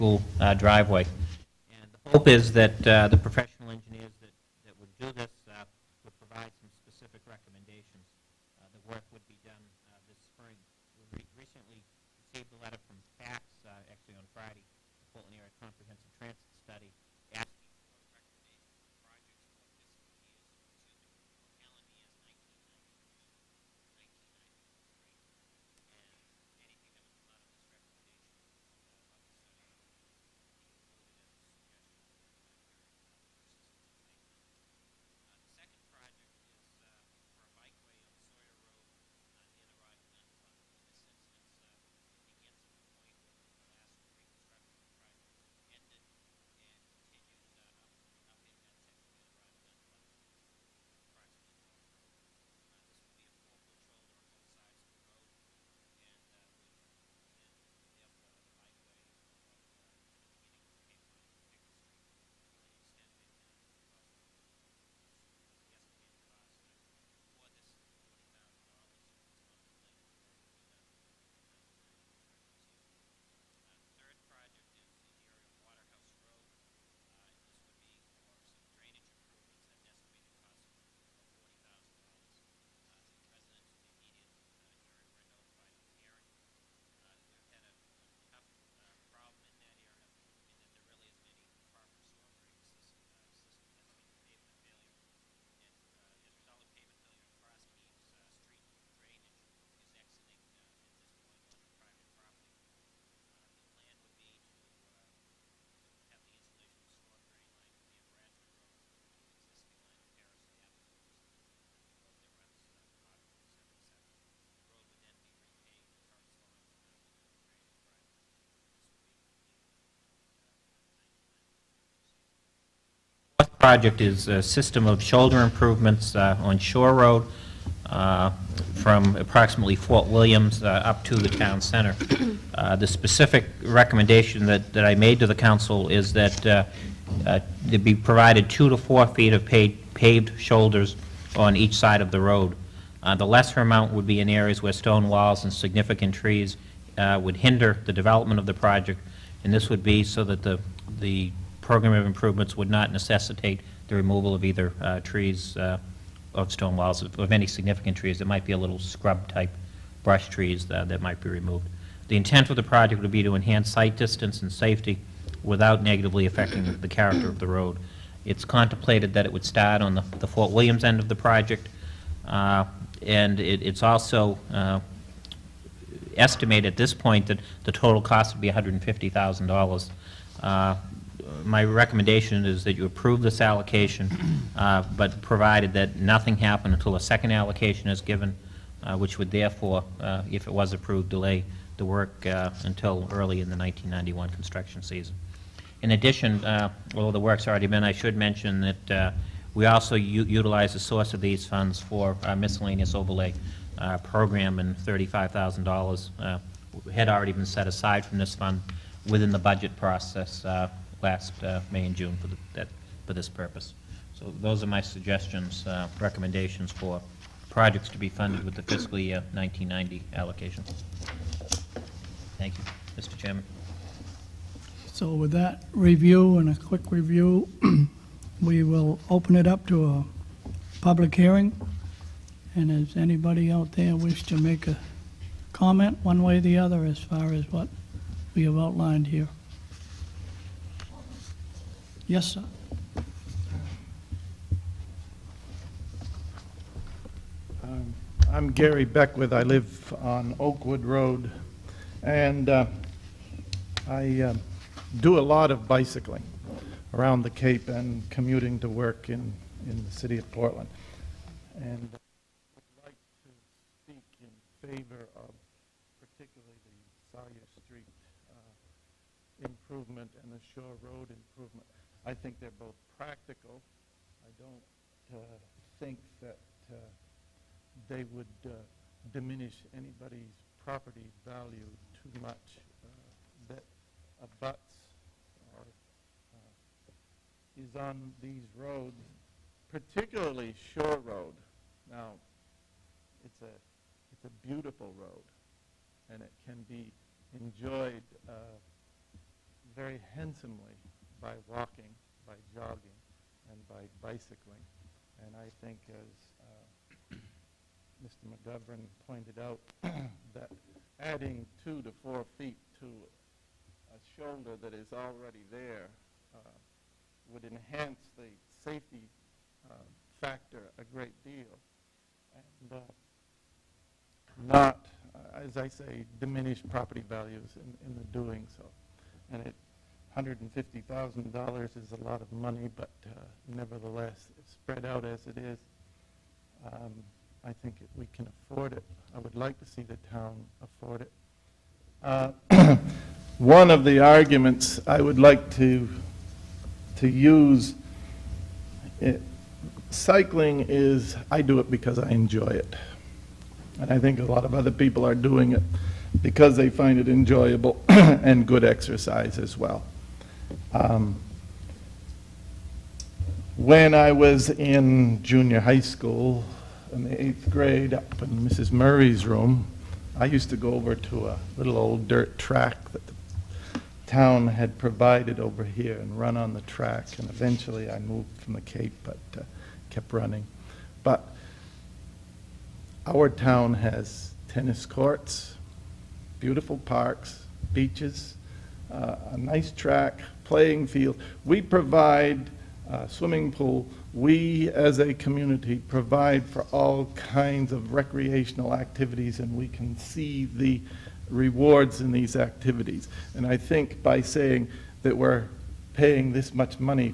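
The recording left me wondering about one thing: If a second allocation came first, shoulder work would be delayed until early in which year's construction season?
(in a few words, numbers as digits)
1991.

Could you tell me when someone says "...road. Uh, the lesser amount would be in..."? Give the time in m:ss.
2:22.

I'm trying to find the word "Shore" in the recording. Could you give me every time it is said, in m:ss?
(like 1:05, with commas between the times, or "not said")
2:06, 4:50.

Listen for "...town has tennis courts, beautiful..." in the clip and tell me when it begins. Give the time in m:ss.
6:23.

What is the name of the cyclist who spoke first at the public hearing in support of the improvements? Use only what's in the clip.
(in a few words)
Gary Beckwith.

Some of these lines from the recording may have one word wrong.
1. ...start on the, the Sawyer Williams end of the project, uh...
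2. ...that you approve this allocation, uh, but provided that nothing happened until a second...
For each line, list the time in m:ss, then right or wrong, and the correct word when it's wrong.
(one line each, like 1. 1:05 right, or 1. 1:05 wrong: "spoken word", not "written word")
1. 2:49 wrong: "Fort", not "Sawyer"
2. 3:02 right.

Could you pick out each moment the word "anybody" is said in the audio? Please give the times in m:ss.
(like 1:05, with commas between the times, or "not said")
3:52, 4:39.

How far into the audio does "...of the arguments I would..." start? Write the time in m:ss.
5:43.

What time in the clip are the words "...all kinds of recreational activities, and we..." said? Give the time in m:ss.
6:36.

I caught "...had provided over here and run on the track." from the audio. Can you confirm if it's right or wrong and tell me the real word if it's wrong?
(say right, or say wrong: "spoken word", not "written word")
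right.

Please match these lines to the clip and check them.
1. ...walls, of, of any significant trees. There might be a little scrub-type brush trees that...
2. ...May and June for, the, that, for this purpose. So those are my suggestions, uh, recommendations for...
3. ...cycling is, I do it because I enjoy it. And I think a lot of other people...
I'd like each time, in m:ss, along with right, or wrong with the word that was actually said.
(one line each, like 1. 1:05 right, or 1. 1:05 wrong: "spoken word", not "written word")
1. 2:36 right
2. 3:31 right
3. 5:49 right.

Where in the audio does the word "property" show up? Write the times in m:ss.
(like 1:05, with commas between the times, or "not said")
4:40, 5:26.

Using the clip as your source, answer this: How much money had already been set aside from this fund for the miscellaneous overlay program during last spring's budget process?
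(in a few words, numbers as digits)
$35,000.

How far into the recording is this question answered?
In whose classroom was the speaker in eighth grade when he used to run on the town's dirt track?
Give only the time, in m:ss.
6:08.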